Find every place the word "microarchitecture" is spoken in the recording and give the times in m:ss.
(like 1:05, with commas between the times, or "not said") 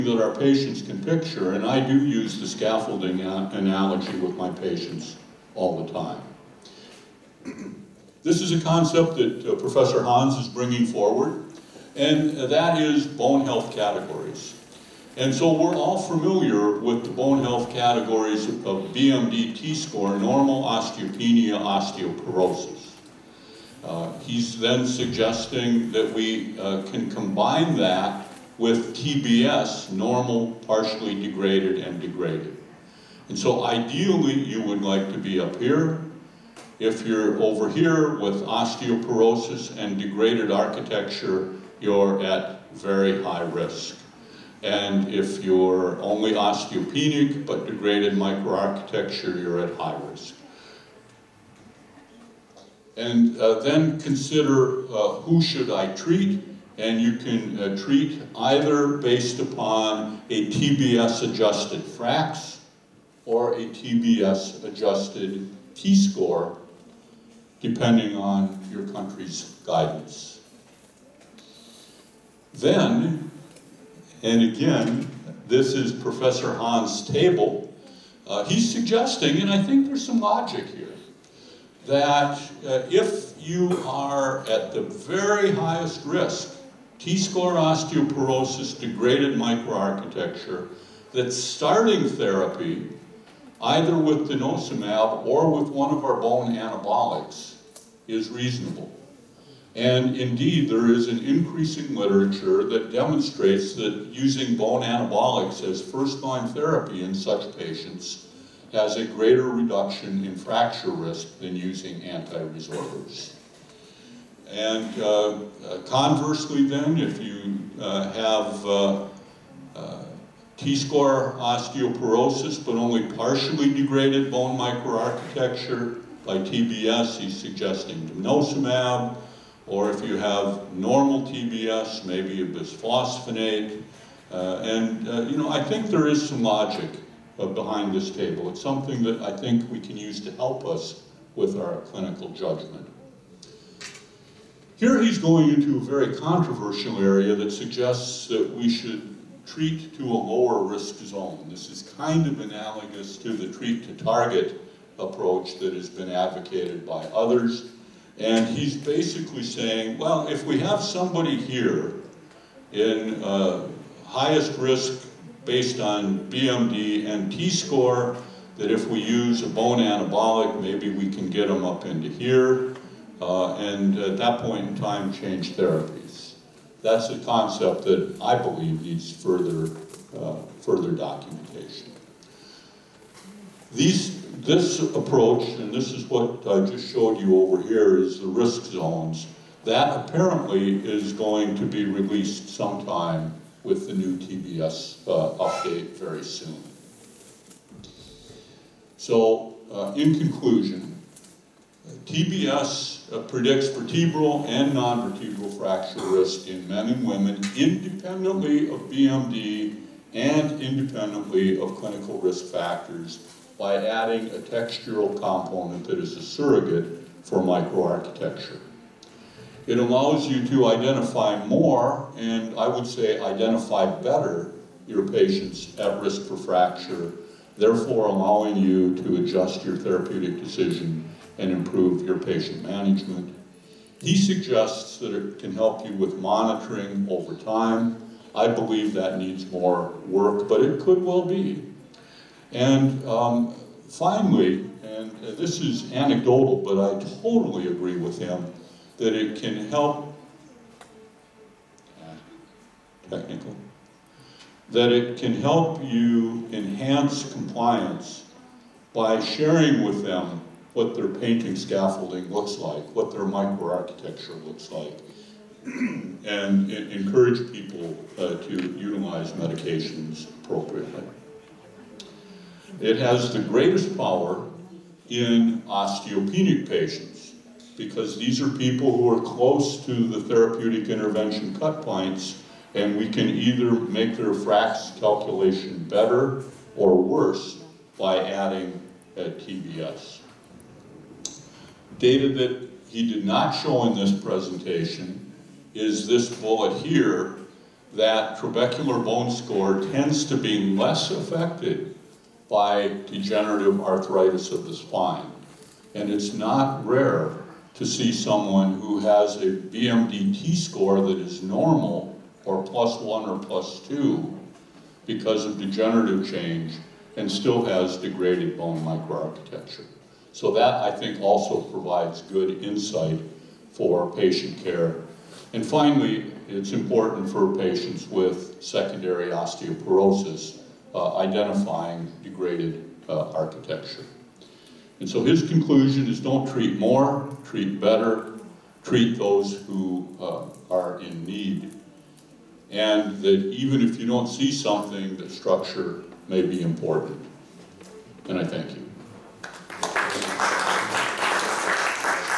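0:48, 1:29, 2:04, 3:37, 4:23, 5:18.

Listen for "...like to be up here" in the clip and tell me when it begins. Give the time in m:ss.
0:34.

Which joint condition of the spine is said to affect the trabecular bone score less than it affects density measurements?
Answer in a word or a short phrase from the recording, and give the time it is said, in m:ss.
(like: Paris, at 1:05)
degenerative arthritis, at 5:03.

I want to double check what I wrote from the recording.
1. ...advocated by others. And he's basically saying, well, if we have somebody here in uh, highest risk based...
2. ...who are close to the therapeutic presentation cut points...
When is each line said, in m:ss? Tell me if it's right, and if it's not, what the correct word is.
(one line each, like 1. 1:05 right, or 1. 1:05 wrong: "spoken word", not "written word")
1. 2:36 right
2. 4:38 wrong: "intervention", not "presentation".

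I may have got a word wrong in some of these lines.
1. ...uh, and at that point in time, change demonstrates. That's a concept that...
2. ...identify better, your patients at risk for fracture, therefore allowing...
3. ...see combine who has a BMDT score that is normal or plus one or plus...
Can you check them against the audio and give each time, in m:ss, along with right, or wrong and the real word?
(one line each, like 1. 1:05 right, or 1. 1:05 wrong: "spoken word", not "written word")
1. 2:53 wrong: "therapies", not "demonstrates"
2. 3:43 right
3. 5:07 wrong: "someone", not "combine".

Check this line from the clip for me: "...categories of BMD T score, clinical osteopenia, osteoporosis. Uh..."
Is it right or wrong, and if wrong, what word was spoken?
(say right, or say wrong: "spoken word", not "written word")
wrong: "normal", not "clinical".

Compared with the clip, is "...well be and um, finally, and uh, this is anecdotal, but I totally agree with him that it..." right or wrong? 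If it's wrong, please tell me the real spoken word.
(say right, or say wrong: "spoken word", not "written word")
right.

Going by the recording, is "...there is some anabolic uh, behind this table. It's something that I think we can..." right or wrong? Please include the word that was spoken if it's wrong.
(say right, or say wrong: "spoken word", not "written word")
wrong: "logic", not "anabolic".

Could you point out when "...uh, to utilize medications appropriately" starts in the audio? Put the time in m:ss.
4:28.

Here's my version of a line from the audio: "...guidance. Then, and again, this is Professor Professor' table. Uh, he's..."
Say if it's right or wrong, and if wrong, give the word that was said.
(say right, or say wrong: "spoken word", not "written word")
wrong: "Hans", not "Professor".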